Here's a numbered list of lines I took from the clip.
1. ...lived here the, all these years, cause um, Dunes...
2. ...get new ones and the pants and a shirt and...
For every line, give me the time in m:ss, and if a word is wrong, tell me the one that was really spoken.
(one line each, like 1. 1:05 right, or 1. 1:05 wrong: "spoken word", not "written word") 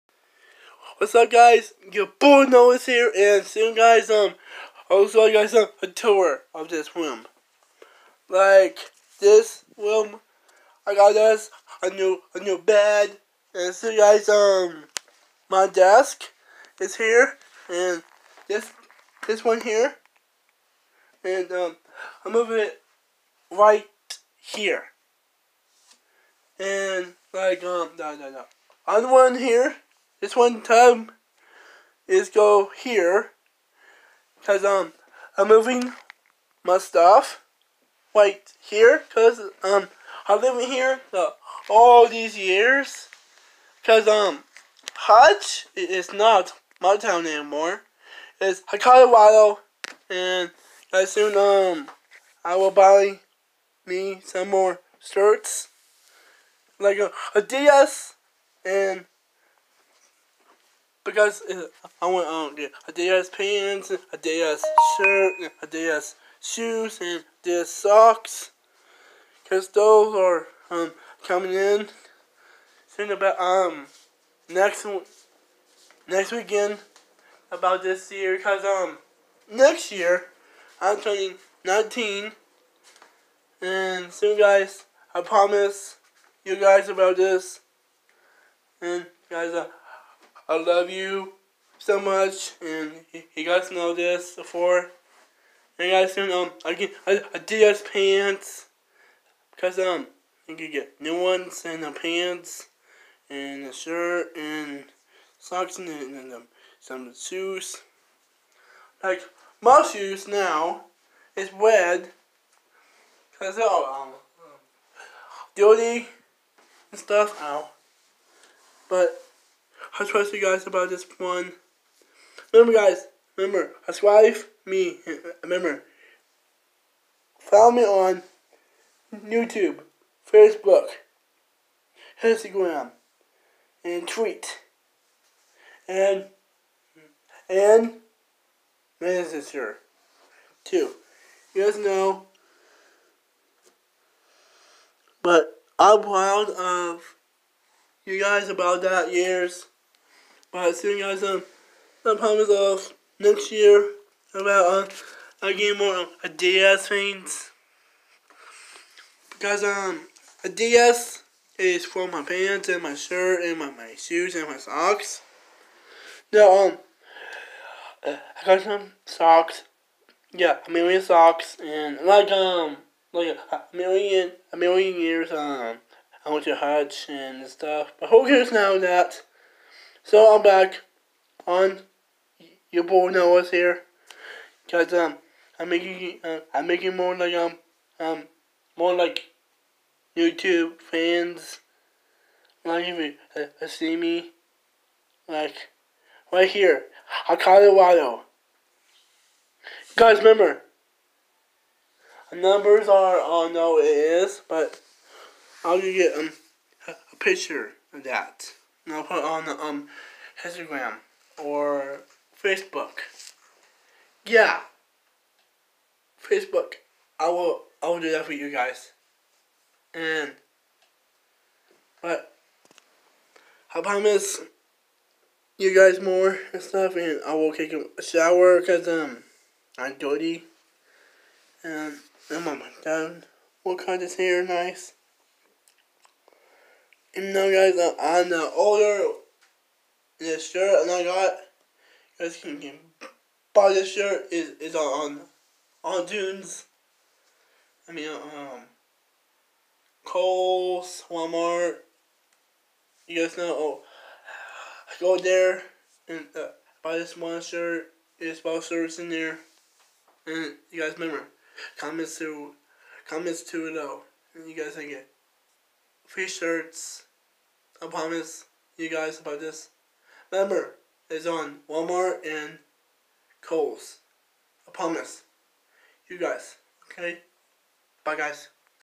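1. 0:40 wrong: "Hutch", not "Dunes"
2. 1:40 right.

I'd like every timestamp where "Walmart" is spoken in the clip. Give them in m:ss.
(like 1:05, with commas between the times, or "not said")
4:11, 4:31.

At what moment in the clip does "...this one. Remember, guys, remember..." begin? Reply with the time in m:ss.
2:00.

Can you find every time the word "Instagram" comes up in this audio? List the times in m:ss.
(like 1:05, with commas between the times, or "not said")
2:12, 3:30.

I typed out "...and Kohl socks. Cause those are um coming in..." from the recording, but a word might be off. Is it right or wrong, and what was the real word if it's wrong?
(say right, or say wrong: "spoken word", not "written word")
wrong: "Adidas", not "Kohl".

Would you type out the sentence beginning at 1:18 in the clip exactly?
Cause um next year I'm turning 19, and soon guys I promise you guys about this and guys.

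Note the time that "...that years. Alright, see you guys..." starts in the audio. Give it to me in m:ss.
2:28.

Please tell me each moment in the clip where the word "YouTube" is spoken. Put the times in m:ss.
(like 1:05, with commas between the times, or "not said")
2:09, 3:10.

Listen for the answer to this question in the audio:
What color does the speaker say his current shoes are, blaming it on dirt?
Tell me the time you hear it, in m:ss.
1:51.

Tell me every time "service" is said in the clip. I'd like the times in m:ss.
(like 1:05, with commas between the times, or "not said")
4:18.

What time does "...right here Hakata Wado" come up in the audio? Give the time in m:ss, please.
3:16.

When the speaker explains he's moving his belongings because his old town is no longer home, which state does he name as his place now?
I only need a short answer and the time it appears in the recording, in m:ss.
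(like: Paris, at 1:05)
Colorado, at 0:48.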